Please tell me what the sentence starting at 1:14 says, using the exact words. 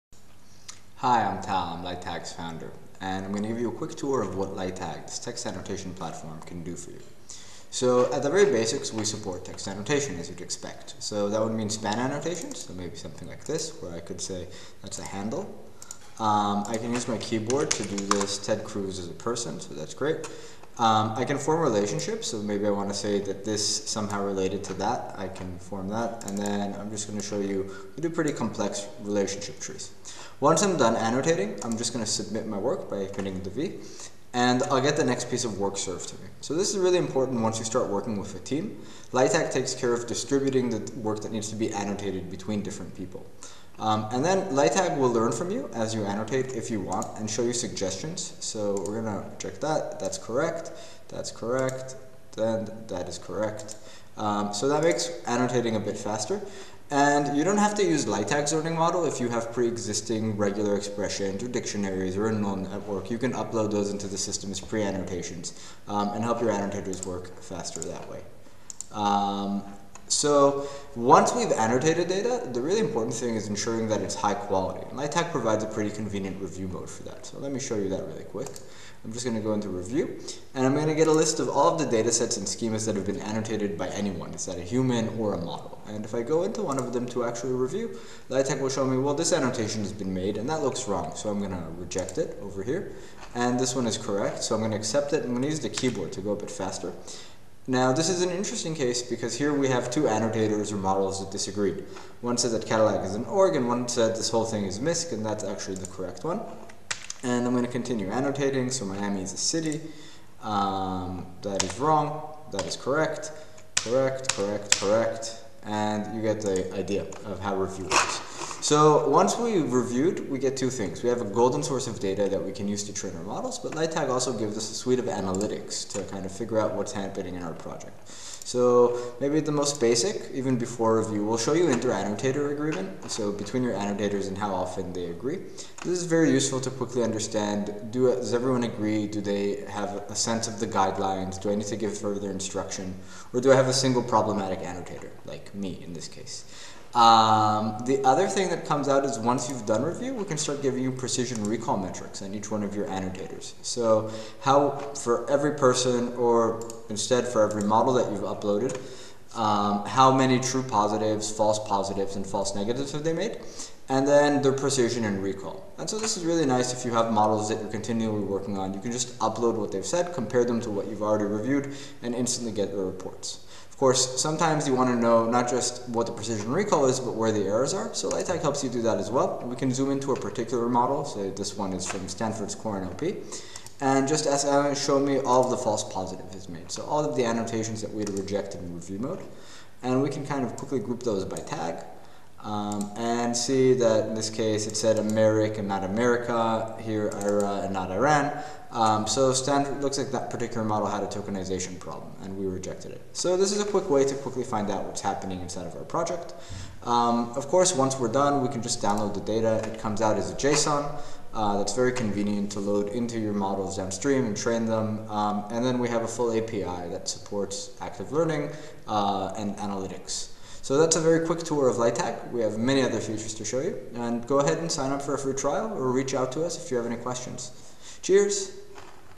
And provides a pretty convenient review mode for that.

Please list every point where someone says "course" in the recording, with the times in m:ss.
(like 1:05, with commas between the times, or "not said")
2:53, 3:27.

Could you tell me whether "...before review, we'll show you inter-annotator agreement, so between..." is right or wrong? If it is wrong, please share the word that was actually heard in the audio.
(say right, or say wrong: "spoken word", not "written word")
right.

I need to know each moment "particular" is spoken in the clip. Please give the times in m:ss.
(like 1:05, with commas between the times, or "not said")
3:00, 3:20.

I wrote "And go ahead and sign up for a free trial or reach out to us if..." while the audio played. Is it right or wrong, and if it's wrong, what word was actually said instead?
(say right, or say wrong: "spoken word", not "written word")
right.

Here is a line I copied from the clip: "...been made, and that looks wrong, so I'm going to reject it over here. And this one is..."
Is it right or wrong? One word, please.
right.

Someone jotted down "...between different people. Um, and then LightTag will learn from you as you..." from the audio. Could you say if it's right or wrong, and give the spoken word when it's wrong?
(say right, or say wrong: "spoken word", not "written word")
right.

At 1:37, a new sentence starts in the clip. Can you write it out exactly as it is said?
Now, this is an interesting case because here we have two annotators or models that disagreed.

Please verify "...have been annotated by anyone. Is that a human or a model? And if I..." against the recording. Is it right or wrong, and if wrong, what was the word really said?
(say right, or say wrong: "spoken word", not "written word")
right.